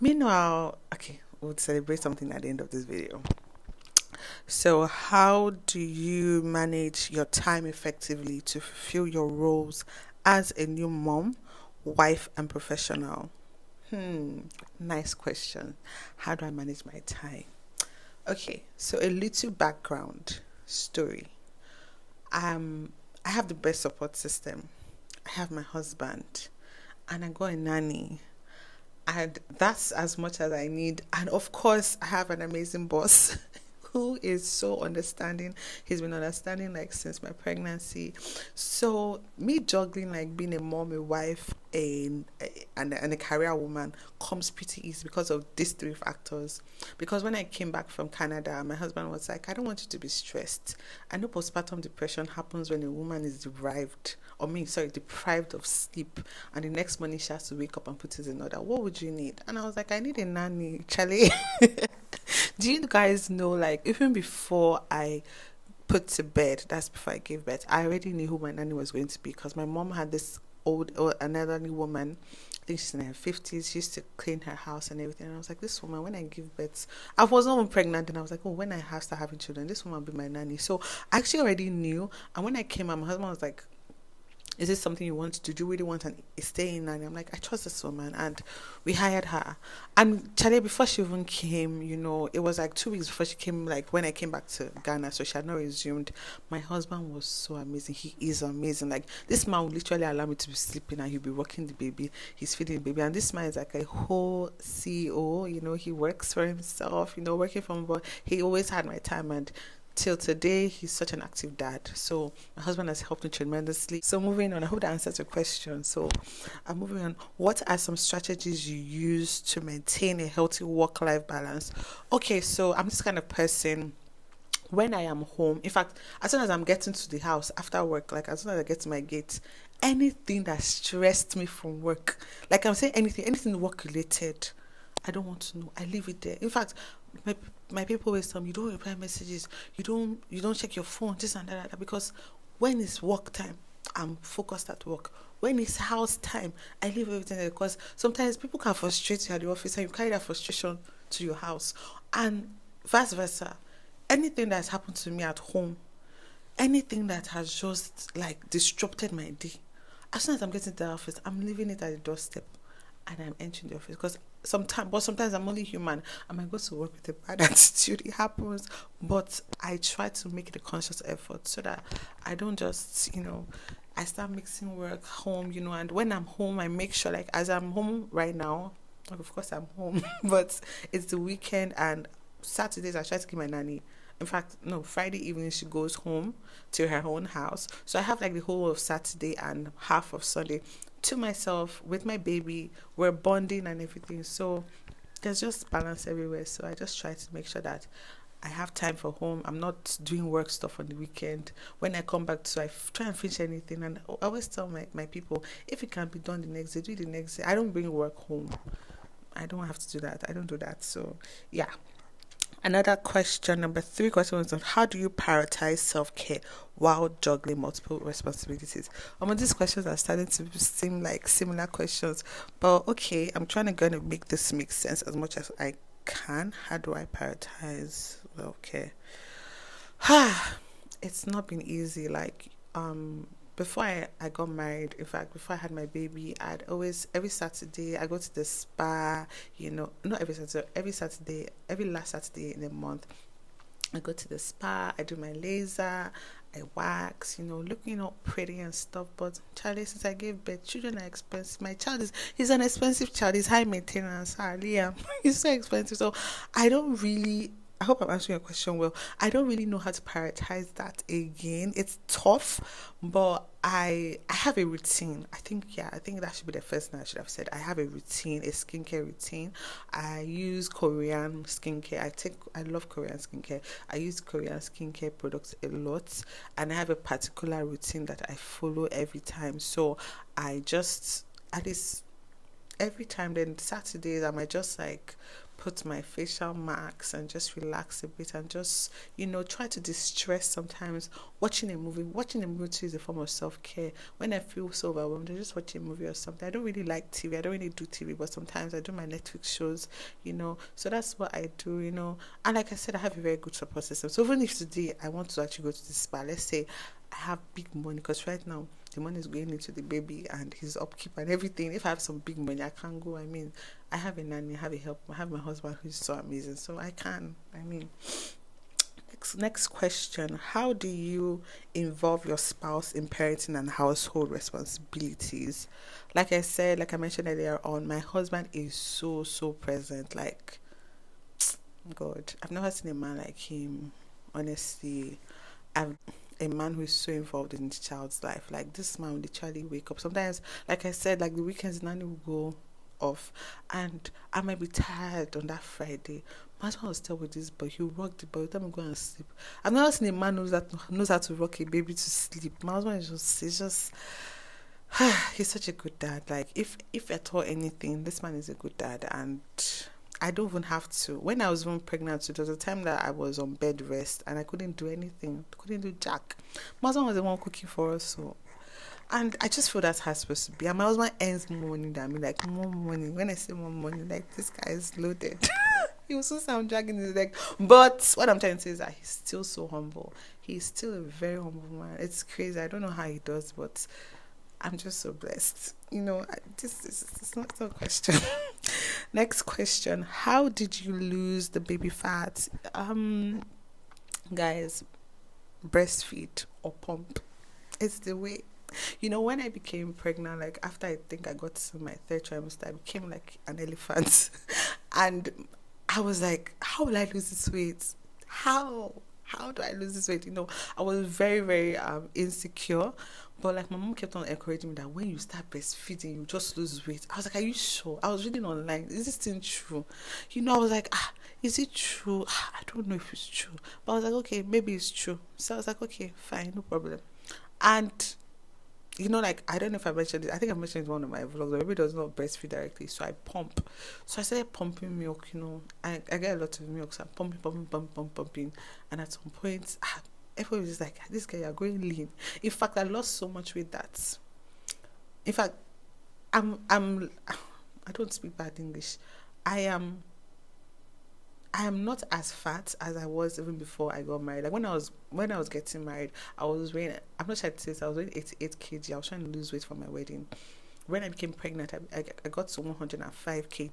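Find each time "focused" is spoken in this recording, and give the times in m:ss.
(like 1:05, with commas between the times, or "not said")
2:24.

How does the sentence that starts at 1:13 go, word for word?
She used to clean her house and everything.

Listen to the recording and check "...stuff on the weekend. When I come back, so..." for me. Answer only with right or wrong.
right.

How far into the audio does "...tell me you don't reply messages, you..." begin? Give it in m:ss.
2:18.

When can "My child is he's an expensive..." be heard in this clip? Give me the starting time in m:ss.
4:11.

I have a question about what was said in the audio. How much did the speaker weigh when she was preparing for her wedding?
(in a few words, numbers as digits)
88 kg.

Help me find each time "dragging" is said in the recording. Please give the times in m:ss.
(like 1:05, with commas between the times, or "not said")
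6:16.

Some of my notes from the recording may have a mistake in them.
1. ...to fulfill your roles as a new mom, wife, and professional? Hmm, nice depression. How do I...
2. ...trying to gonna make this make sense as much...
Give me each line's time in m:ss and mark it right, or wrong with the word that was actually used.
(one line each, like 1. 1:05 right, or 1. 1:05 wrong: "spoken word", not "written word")
1. 0:08 wrong: "question", not "depression"
2. 3:43 right.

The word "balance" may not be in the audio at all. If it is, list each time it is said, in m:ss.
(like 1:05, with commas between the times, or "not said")
2:01, 3:15.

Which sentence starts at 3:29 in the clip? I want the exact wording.
I don't have to do that.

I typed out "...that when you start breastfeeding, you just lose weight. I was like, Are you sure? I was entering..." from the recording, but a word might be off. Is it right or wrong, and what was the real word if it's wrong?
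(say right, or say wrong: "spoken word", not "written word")
wrong: "reading", not "entering".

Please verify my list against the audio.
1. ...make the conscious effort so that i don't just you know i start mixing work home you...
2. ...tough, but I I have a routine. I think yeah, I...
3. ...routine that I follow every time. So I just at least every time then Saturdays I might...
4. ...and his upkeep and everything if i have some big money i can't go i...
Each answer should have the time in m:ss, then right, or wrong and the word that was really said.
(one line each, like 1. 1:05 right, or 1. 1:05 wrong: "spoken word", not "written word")
1. 2:50 right
2. 4:22 right
3. 4:37 right
4. 5:10 right.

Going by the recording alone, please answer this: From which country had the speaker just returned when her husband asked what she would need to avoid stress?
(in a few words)
Canada.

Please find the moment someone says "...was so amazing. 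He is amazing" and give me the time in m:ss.
1:37.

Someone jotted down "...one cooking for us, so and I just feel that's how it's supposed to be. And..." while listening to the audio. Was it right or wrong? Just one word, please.
right.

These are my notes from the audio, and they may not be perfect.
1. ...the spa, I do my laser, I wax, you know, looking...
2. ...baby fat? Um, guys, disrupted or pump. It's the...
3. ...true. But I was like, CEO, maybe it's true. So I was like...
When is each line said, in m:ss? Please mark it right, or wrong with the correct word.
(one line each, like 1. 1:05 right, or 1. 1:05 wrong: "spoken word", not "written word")
1. 4:04 right
2. 6:31 wrong: "breastfeed", not "disrupted"
3. 7:03 wrong: "Okay", not "CEO".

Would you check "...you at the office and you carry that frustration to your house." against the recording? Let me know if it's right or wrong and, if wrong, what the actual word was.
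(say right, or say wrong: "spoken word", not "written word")
right.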